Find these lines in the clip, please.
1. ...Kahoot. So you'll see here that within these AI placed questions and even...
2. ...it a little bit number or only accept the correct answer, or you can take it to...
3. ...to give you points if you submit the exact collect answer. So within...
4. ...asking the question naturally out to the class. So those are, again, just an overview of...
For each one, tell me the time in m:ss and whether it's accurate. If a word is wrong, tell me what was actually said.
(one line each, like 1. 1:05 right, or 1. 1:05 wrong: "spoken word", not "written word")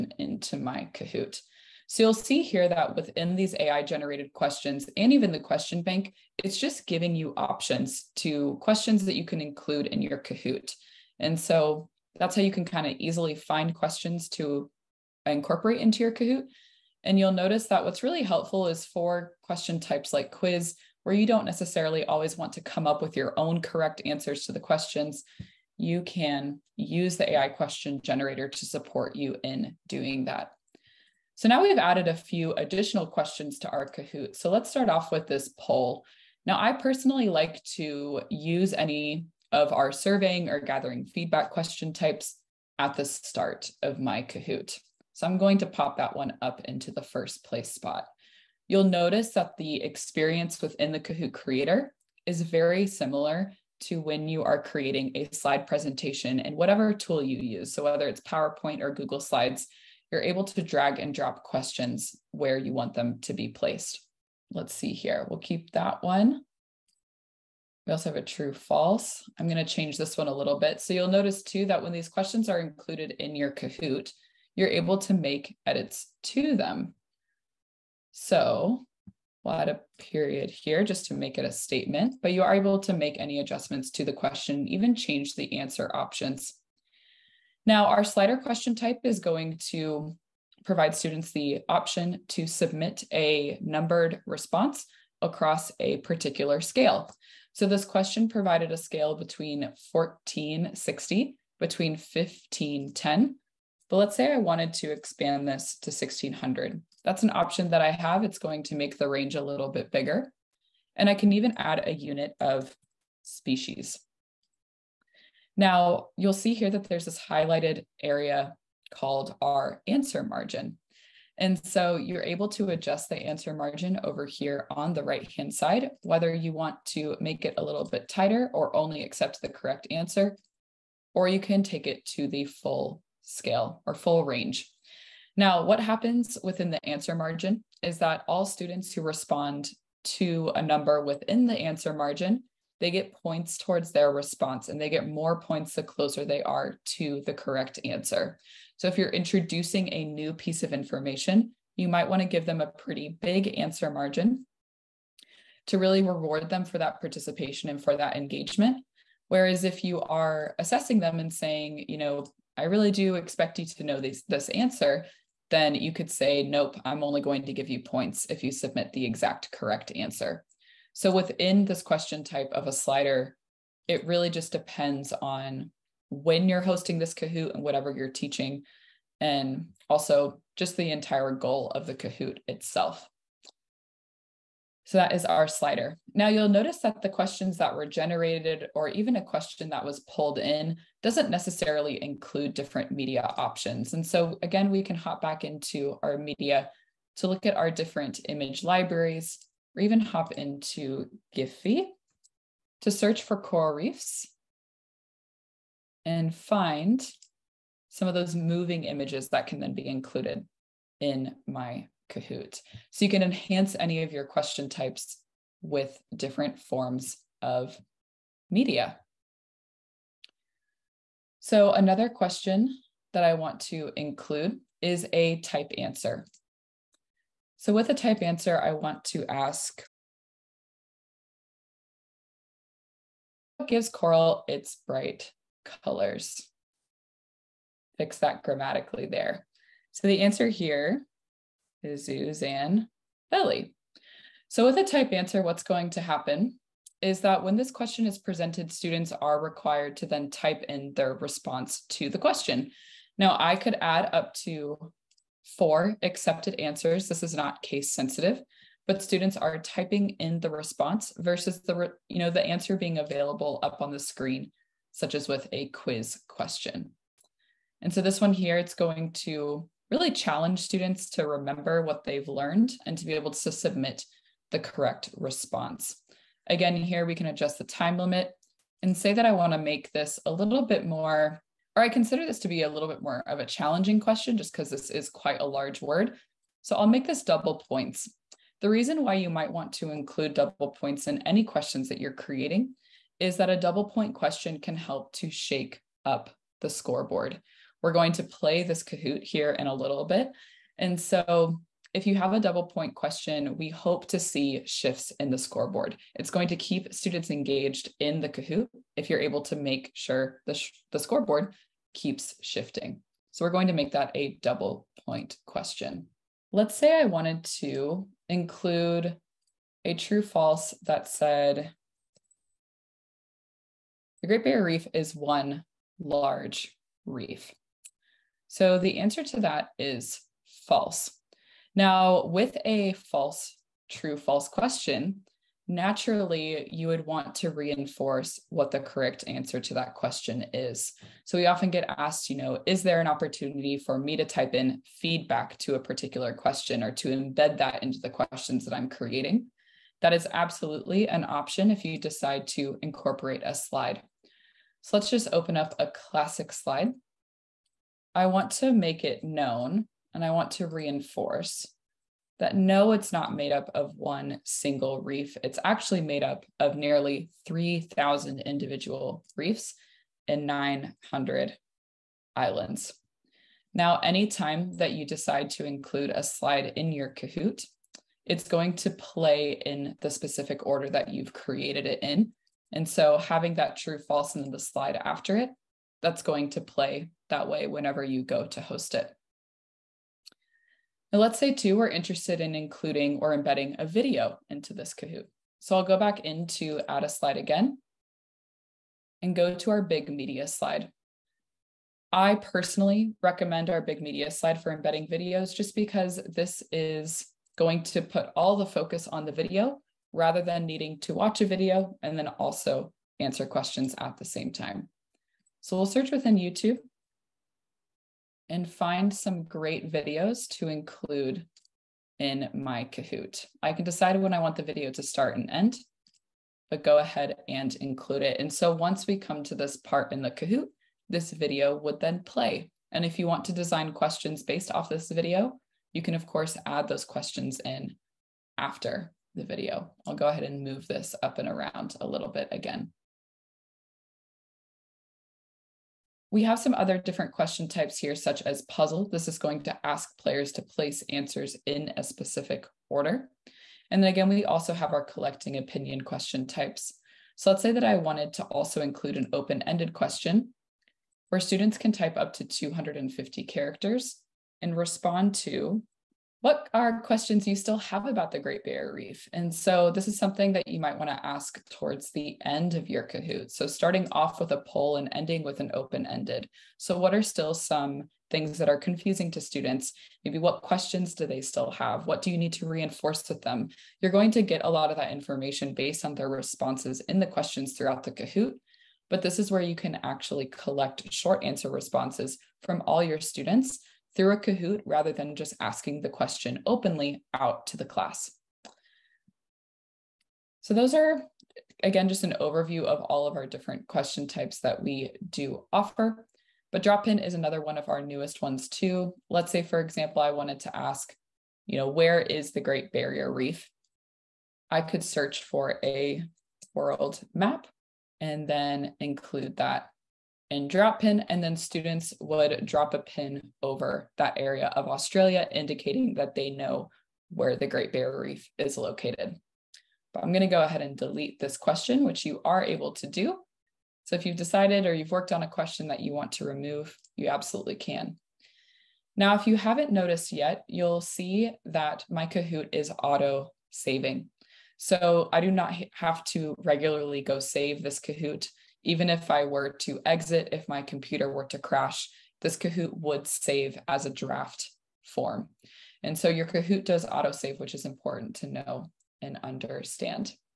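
1. 0:00 wrong: "generated", not "placed"
2. 2:07 wrong: "tighter", not "number"
3. 2:47 wrong: "correct", not "collect"
4. 8:15 wrong: "openly", not "naturally".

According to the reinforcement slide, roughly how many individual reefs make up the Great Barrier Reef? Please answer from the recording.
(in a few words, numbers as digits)
3,000.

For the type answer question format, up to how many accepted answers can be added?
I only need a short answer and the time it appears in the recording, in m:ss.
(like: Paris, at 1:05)
4, at 4:15.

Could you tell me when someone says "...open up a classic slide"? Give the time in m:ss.
5:55.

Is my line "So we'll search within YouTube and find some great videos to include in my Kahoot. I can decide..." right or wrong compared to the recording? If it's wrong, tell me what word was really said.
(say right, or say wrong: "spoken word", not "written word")
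right.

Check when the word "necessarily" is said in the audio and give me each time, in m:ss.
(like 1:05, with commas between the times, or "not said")
0:21, 3:11.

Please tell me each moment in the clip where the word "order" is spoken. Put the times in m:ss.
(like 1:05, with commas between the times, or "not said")
6:20, 7:32.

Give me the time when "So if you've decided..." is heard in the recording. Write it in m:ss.
8:54.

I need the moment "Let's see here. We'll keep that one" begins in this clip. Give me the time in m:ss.
1:04.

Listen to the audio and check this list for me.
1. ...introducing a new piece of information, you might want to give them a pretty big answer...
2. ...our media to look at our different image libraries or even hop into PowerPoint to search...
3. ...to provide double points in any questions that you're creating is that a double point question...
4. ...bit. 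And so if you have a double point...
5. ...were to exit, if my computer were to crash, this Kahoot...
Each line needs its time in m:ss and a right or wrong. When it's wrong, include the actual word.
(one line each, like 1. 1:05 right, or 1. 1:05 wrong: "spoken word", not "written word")
1. 2:29 right
2. 3:16 wrong: "Giphy", not "PowerPoint"
3. 4:49 wrong: "include", not "provide"
4. 5:00 right
5. 9:09 right.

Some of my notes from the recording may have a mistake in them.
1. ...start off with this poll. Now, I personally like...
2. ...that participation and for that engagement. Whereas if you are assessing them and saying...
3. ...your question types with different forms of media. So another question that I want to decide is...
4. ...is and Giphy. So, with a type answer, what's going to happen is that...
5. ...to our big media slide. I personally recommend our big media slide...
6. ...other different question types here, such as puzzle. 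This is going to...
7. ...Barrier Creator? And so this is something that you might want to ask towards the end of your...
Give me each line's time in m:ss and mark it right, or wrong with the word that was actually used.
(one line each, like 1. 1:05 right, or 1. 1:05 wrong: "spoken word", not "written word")
1. 0:34 right
2. 2:36 right
3. 3:34 wrong: "include", not "decide"
4. 4:01 wrong: "Belly", not "Giphy"
5. 6:39 right
6. 7:26 right
7. 7:48 wrong: "Reef", not "Creator".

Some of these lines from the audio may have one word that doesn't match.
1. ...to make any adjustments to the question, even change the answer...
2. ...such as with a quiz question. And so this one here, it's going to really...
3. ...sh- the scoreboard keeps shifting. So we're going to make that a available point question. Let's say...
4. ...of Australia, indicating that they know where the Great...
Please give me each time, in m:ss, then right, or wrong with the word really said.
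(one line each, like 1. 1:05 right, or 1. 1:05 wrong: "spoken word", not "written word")
1. 1:22 right
2. 4:24 right
3. 5:10 wrong: "double", not "available"
4. 8:44 right.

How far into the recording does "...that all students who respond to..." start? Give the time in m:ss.
2:17.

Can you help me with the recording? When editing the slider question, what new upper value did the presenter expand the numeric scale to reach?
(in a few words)
1600.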